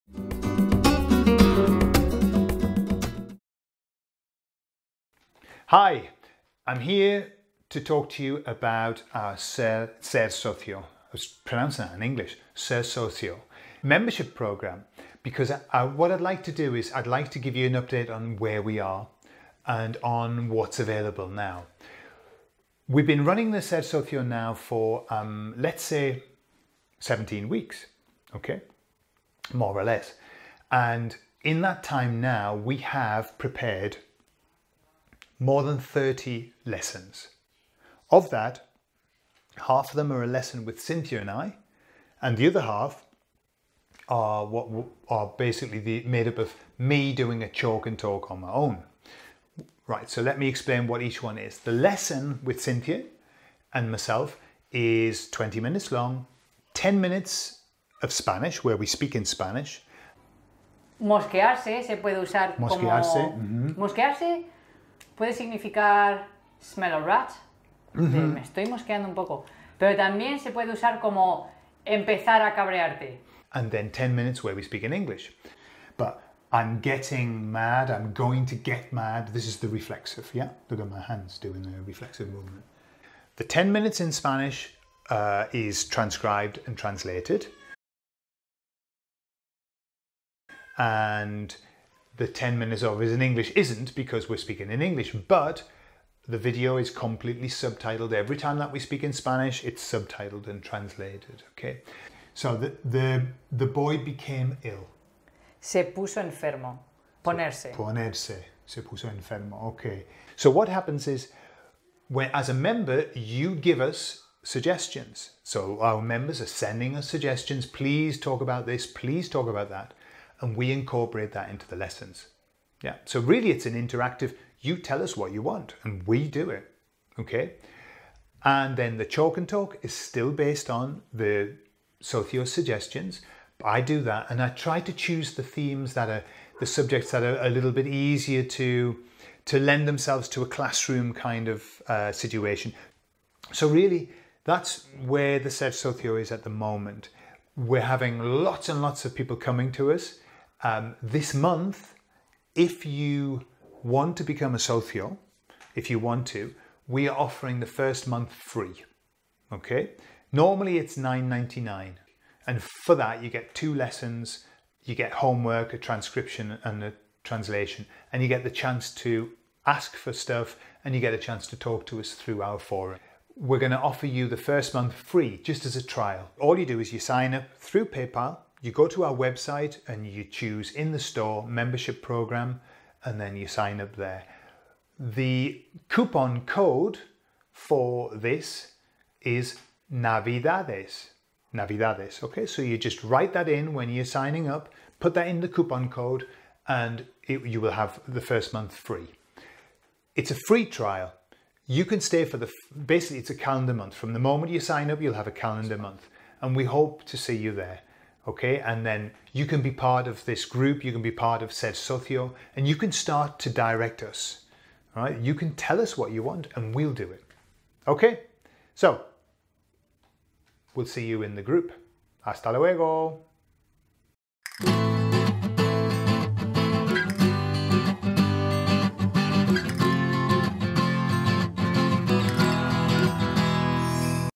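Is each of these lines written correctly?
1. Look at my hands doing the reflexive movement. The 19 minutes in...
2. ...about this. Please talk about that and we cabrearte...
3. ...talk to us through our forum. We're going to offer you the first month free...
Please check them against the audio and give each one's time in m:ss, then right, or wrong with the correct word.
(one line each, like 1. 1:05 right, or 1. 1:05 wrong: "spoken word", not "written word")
1. 1:20 wrong: "10", not "19"
2. 1:58 wrong: "incorporate", not "cabrearte"
3. 2:51 right.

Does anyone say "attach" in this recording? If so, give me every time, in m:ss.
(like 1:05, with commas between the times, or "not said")
not said.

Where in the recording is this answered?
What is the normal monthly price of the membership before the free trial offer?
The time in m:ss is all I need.
2:40.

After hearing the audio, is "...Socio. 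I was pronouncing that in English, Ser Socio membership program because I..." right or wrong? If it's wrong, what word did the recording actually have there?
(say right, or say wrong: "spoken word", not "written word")
right.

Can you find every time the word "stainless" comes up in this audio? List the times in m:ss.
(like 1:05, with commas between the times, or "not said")
not said.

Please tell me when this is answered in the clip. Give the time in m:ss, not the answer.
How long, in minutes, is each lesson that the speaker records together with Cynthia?
0:55.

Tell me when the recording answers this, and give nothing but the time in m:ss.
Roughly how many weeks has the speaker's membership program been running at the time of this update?
0:26.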